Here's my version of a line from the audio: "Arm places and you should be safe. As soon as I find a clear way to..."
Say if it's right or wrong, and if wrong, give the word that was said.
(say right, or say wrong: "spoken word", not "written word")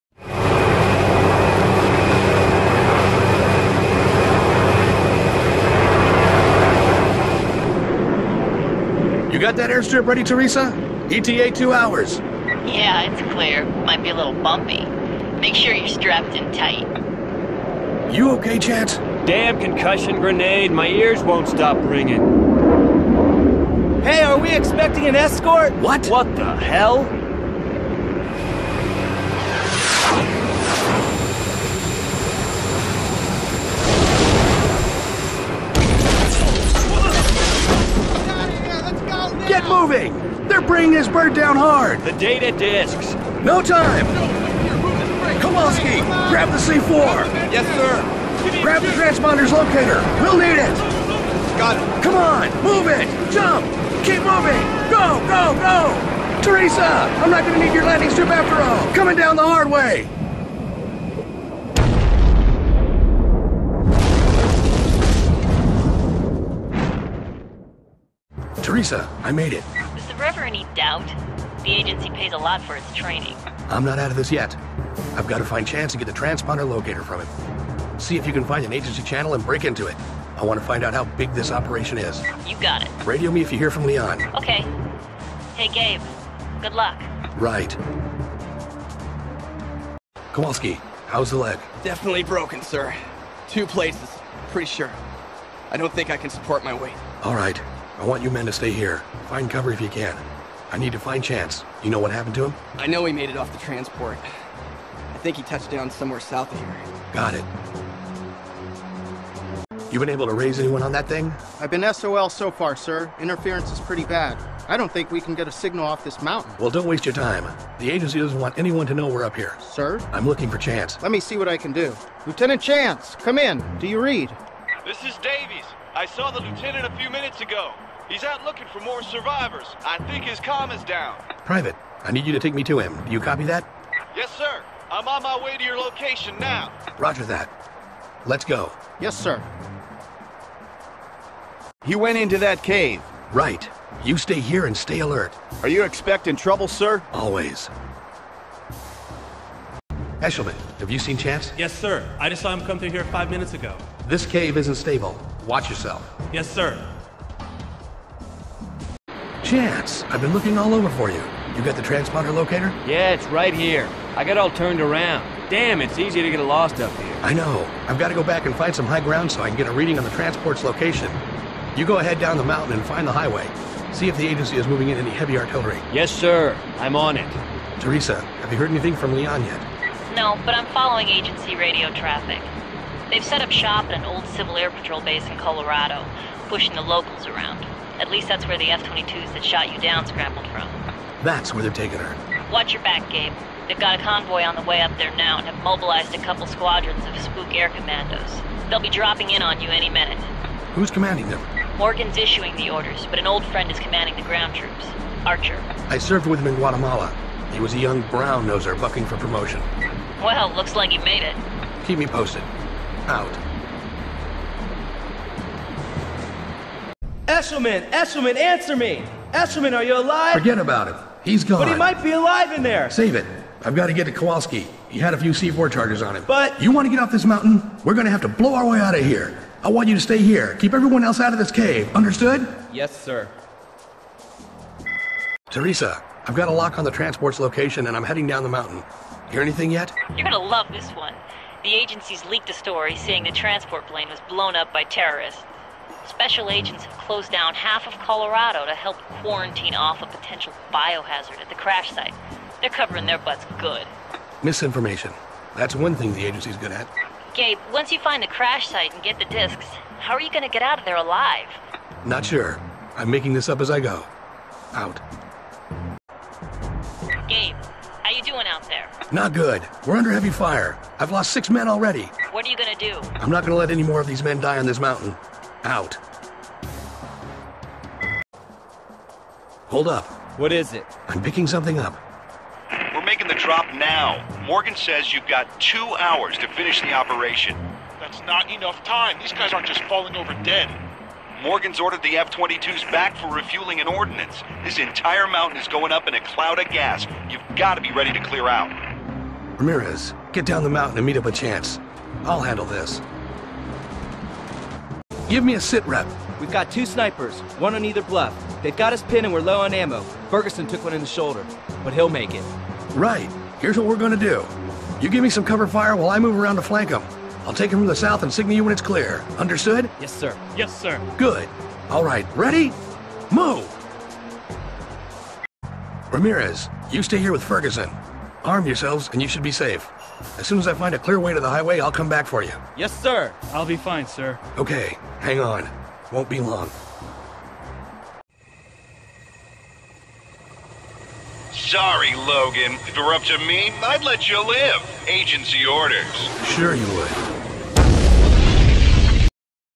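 wrong: "yourselves", not "places".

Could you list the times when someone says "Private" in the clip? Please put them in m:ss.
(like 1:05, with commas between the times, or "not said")
2:11.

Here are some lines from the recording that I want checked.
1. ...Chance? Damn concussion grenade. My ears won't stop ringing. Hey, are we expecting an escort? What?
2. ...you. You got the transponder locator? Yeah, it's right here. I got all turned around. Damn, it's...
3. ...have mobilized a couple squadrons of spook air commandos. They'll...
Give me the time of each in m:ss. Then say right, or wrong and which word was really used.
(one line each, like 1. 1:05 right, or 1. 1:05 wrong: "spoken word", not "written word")
1. 0:18 right
2. 2:41 right
3. 3:15 right.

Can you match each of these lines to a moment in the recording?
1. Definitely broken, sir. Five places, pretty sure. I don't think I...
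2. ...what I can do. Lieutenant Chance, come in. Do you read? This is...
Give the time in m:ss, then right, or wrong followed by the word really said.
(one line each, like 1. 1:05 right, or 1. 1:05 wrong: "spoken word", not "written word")
1. 1:31 wrong: "Two", not "Five"
2. 2:01 right.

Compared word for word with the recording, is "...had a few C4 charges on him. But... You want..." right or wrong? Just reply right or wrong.
right.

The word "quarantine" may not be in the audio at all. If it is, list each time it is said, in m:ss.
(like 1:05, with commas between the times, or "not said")
4:09.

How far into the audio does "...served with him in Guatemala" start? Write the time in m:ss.
3:25.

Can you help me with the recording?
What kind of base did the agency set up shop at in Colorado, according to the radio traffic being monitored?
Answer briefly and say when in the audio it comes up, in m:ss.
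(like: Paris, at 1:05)
Civil Air Patrol base, at 3:04.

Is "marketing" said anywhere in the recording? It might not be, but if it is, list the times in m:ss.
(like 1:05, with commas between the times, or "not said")
not said.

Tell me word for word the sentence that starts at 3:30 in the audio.
Well, looks like he made it.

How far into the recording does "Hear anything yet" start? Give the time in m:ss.
3:59.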